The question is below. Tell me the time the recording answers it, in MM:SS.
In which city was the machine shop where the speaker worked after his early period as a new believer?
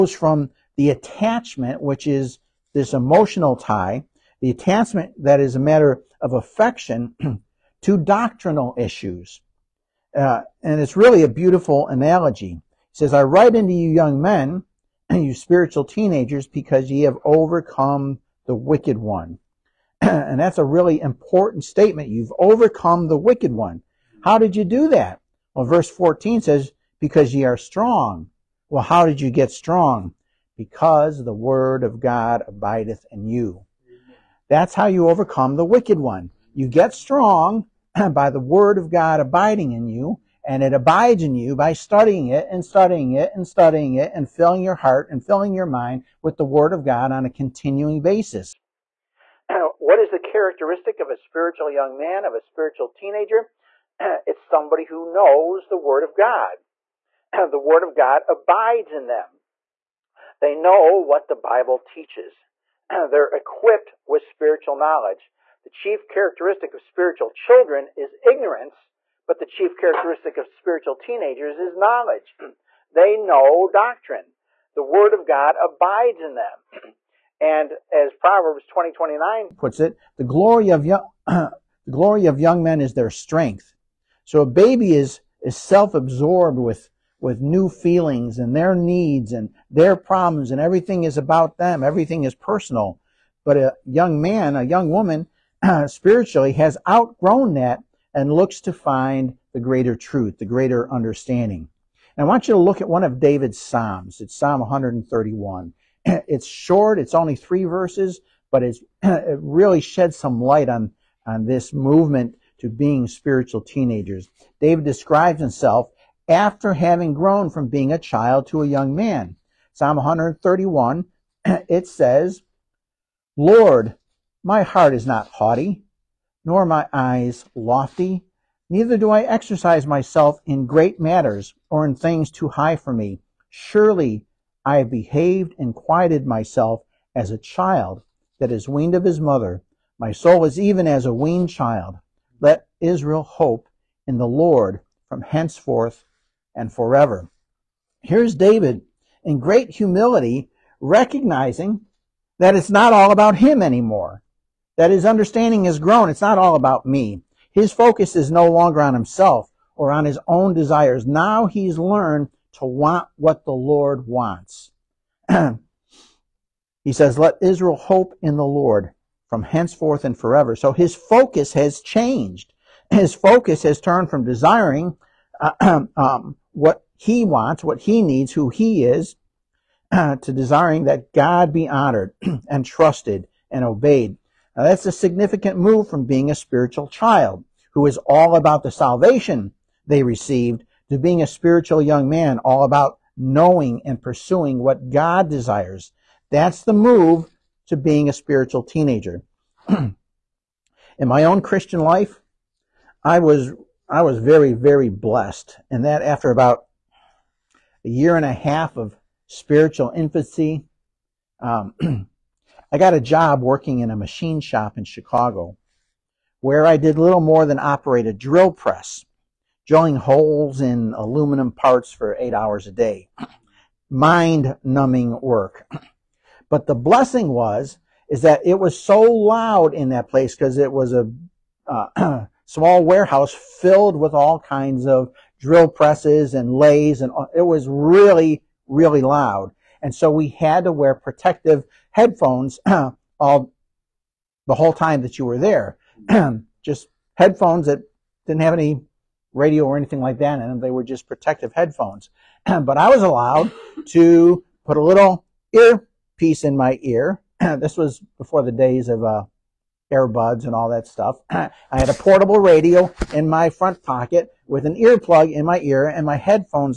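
03:34.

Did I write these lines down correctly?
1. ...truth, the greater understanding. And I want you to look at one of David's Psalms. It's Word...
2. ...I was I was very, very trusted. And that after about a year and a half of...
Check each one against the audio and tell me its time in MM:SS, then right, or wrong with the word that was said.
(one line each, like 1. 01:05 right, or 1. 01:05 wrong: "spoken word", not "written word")
1. 01:39 wrong: "Psalm", not "Word"
2. 03:23 wrong: "blessed", not "trusted".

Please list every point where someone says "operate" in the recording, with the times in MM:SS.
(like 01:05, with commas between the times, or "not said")
03:37.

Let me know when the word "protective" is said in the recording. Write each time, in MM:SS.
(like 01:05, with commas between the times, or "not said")
04:00, 04:11.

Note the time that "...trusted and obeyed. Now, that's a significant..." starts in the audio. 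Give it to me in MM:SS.
03:02.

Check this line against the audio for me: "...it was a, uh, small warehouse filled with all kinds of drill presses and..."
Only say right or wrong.
right.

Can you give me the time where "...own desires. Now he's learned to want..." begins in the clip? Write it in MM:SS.
02:40.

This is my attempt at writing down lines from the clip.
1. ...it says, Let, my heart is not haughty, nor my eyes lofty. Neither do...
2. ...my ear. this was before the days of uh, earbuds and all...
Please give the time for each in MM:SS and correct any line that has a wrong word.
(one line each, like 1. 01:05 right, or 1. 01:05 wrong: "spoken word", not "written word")
1. 02:01 wrong: "Lord", not "Let"
2. 04:16 right.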